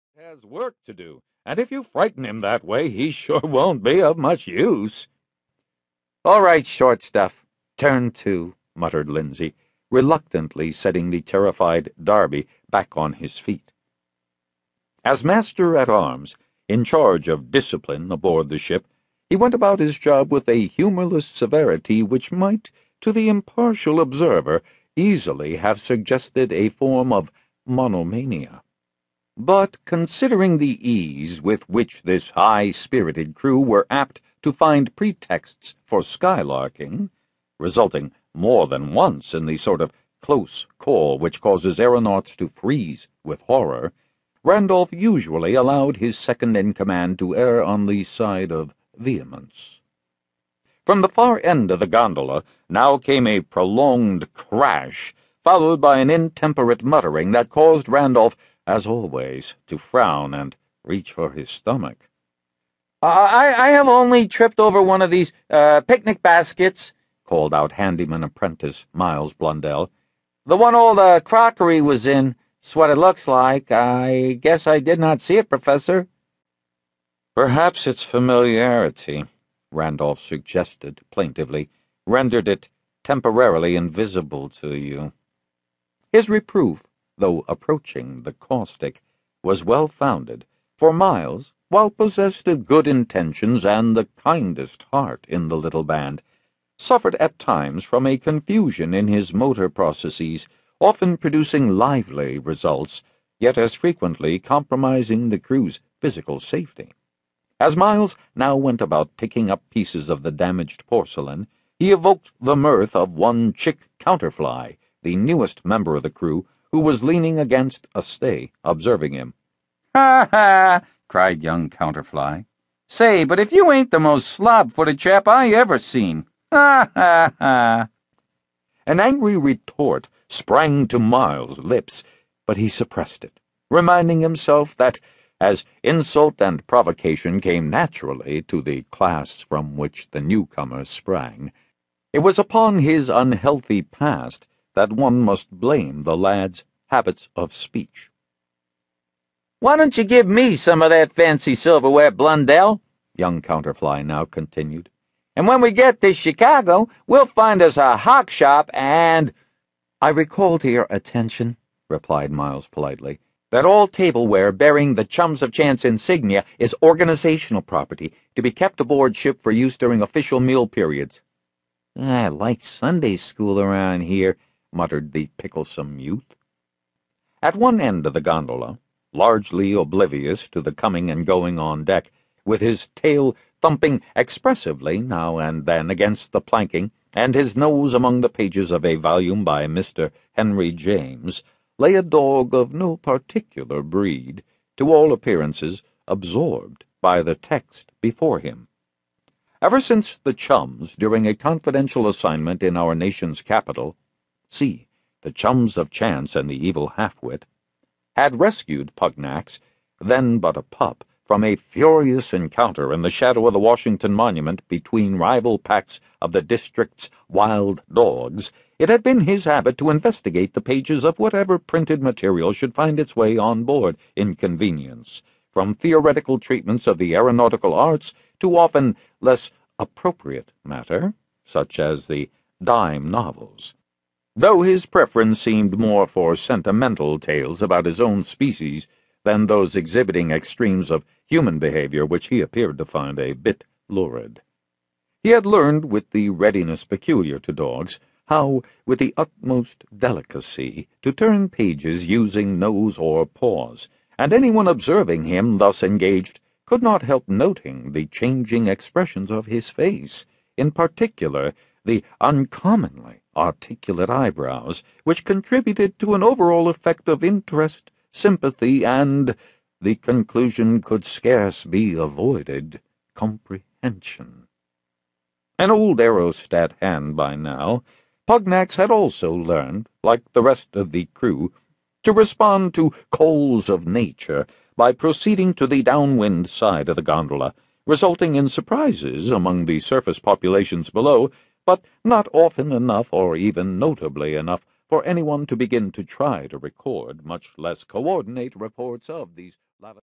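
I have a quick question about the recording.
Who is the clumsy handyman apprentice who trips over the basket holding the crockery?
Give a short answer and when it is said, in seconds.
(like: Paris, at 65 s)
Miles Blundell, at 68 s.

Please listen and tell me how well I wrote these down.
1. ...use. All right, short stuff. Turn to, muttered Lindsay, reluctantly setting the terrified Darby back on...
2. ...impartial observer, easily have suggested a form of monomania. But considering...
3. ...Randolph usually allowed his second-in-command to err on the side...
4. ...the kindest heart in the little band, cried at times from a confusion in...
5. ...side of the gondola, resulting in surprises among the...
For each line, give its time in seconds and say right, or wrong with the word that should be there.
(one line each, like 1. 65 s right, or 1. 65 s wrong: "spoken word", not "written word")
1. 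4 s right
2. 23 s right
3. 44 s right
4. 93 s wrong: "suffered", not "cried"
5. 286 s right.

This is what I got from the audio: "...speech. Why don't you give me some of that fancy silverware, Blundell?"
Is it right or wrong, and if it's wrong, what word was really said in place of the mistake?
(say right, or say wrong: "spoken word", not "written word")
right.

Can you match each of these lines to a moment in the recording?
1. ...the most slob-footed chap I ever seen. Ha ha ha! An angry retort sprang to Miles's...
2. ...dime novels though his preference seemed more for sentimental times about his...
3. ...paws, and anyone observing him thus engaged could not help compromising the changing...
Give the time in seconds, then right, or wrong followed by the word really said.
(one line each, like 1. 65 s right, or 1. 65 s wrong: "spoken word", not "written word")
1. 123 s right
2. 232 s wrong: "tales", not "times"
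3. 253 s wrong: "noting", not "compromising".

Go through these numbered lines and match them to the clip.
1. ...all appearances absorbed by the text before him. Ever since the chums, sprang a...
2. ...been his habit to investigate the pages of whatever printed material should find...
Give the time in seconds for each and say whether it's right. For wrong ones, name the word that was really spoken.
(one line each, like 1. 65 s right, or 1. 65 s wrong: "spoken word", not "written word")
1. 194 s wrong: "during", not "sprang"
2. 219 s right.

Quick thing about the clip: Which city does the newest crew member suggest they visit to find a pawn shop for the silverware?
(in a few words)
Chicago.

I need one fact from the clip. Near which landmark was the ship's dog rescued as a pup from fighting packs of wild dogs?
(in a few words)
Washington Monument.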